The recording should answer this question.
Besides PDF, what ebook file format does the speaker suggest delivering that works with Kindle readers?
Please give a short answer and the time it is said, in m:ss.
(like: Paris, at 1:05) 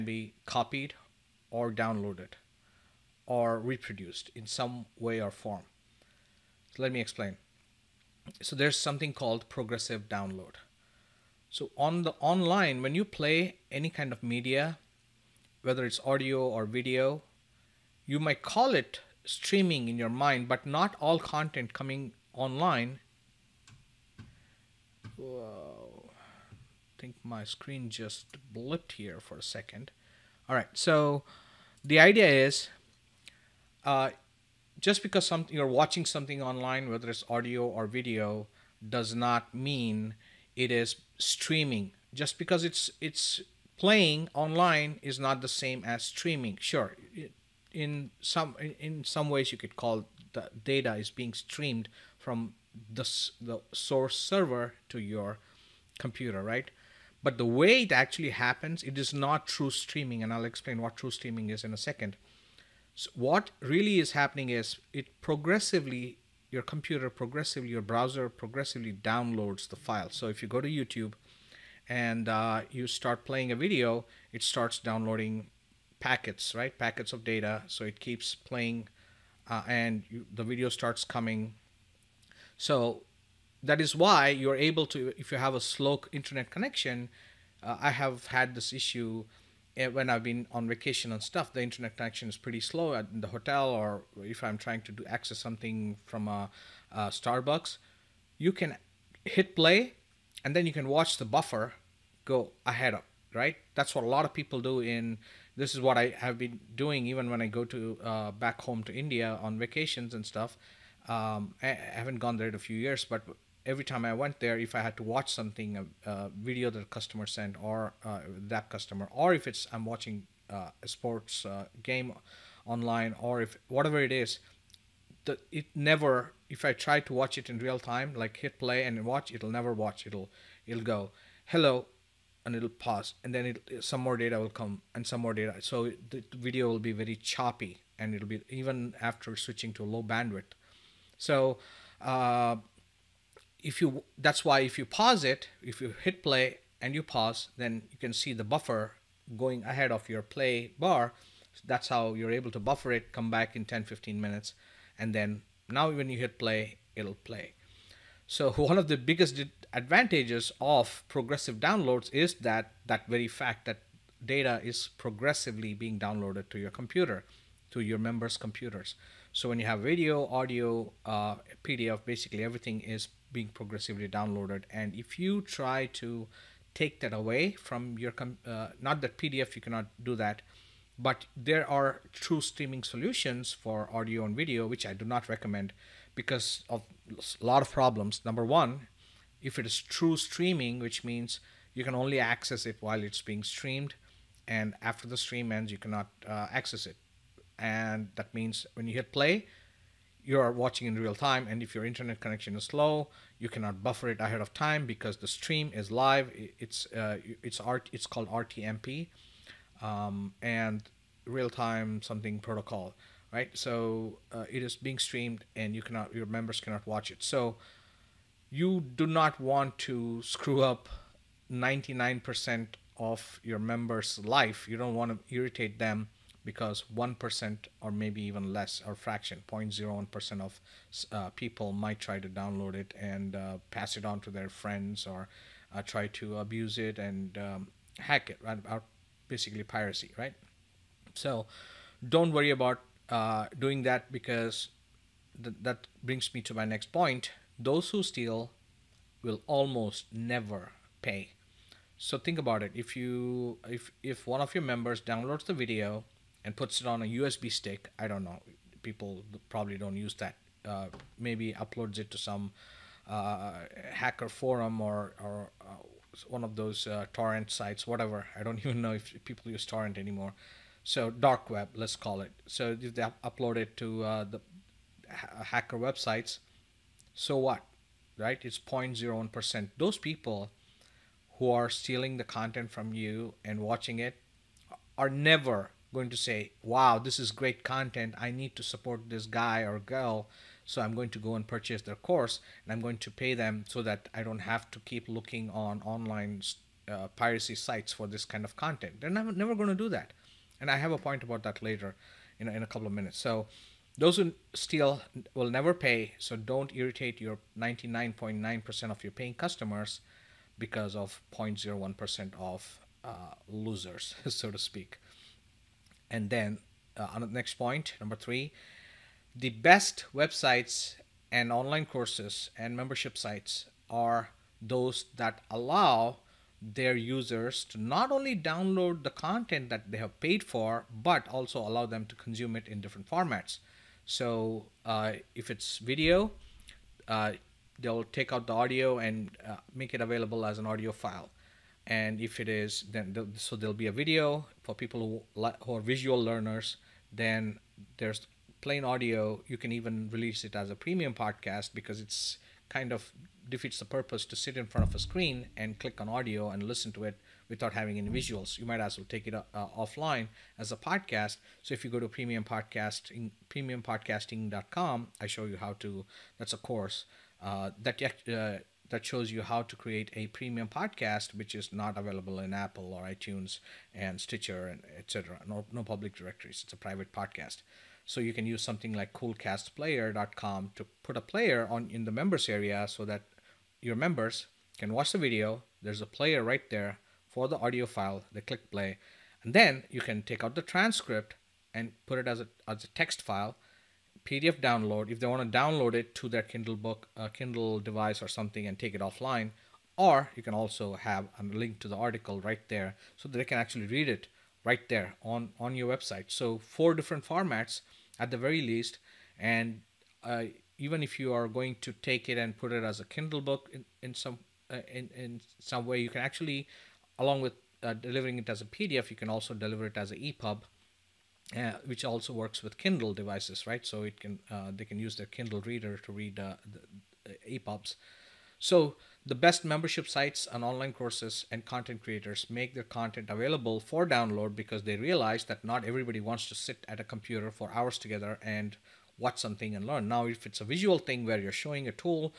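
EPUB, at 7:00.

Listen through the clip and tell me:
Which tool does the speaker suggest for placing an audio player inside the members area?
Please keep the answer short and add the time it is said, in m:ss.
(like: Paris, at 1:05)
coolcastplayer.com, at 6:19.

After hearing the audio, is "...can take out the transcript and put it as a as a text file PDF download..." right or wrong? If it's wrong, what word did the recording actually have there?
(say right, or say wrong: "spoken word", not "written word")
right.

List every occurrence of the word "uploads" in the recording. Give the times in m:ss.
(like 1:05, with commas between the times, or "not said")
4:21, 4:33.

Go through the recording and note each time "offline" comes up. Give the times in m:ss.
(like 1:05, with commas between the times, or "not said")
5:59, 6:39.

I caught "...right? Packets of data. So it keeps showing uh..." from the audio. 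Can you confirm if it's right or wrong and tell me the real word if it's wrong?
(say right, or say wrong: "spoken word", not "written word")
wrong: "playing", not "showing".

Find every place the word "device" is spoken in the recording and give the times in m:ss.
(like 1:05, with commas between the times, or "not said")
6:37, 7:03.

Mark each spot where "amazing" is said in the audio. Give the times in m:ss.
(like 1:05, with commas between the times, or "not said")
not said.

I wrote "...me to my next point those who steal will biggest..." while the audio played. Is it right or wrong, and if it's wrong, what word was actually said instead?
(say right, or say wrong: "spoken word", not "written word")
wrong: "almost", not "biggest".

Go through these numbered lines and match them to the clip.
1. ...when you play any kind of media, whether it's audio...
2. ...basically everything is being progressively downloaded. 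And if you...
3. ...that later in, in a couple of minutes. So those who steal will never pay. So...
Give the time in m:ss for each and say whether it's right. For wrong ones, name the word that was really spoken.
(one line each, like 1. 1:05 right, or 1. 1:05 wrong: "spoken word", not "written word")
1. 0:12 right
2. 2:52 right
3. 5:01 right.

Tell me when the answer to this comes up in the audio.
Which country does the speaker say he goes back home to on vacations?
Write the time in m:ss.
1:48.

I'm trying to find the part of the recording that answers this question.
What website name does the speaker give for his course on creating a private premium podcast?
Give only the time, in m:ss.
6:03.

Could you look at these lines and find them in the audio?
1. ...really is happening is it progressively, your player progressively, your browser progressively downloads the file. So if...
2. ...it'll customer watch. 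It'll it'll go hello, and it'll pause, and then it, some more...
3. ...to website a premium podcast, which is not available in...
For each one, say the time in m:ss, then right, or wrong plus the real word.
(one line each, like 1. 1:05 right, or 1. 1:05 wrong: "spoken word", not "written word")
1. 1:03 wrong: "computer", not "player"
2. 2:09 wrong: "never", not "customer"
3. 6:09 wrong: "create", not "website".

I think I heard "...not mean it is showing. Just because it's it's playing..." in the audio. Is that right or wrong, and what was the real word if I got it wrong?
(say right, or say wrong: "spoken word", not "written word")
wrong: "streaming", not "showing".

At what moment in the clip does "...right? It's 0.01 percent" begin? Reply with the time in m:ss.
4:38.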